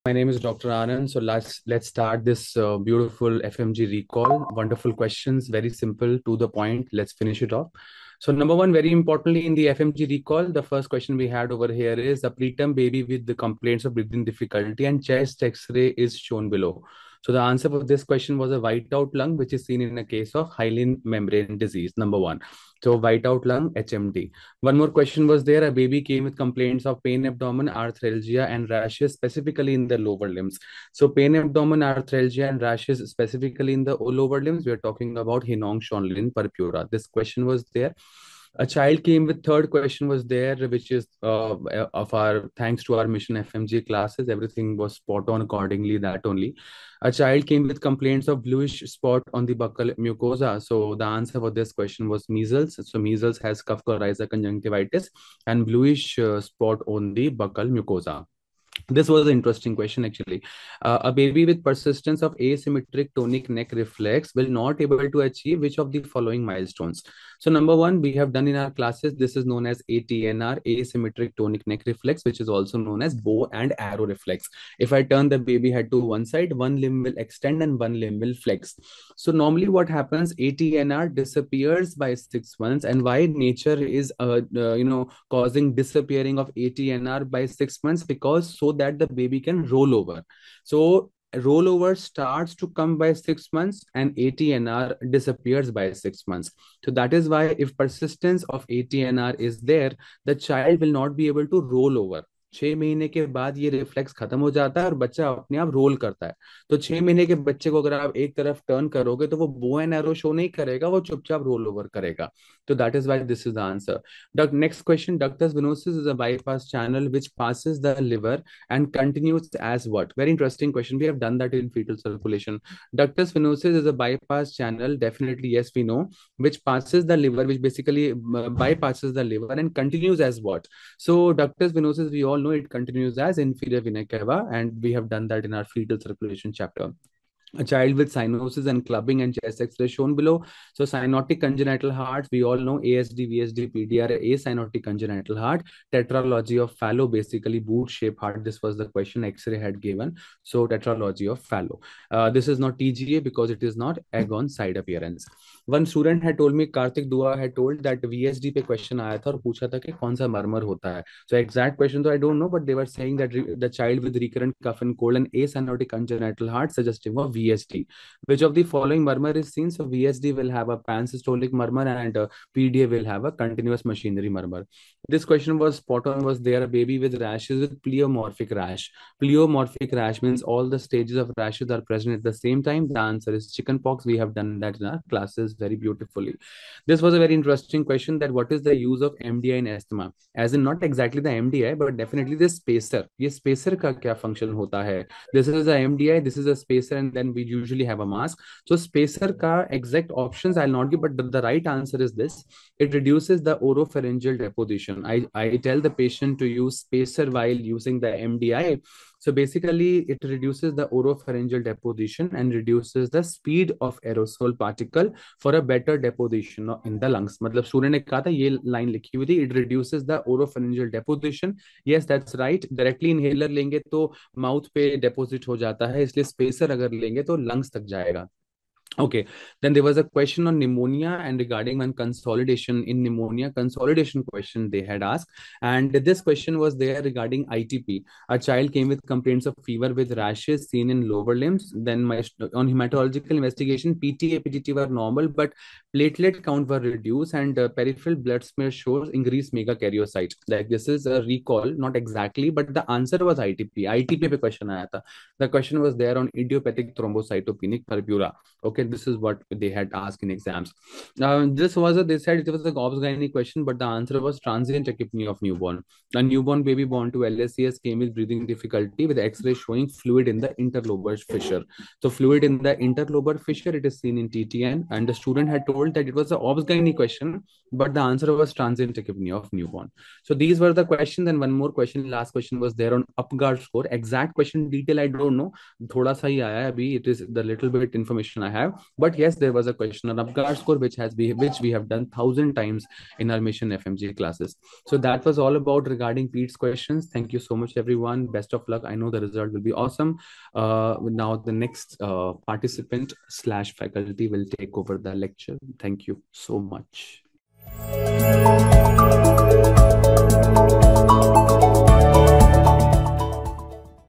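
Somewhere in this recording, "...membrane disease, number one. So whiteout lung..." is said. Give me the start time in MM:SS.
00:21.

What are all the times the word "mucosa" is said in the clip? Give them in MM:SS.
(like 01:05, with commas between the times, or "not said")
00:49, 00:57.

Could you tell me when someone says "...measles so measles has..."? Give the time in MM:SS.
00:52.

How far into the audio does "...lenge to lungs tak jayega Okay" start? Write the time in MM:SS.
03:47.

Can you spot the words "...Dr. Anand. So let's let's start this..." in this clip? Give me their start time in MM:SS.
00:00.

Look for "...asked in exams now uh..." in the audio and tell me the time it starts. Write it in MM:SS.
04:20.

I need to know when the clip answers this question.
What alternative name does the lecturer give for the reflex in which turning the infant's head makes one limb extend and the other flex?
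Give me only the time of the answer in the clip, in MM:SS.
01:13.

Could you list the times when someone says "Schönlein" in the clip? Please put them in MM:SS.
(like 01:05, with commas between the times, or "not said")
00:35.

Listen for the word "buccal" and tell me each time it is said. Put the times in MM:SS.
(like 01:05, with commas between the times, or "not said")
00:49, 00:57.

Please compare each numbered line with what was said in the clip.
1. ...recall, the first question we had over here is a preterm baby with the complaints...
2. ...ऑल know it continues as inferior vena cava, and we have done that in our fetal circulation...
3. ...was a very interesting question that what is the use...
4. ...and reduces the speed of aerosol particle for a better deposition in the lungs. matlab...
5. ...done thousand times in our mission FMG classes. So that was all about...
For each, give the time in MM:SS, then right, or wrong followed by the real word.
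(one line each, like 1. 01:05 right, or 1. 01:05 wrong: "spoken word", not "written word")
1. 00:10 right
2. 02:12 right
3. 03:07 right
4. 03:32 right
5. 04:51 right.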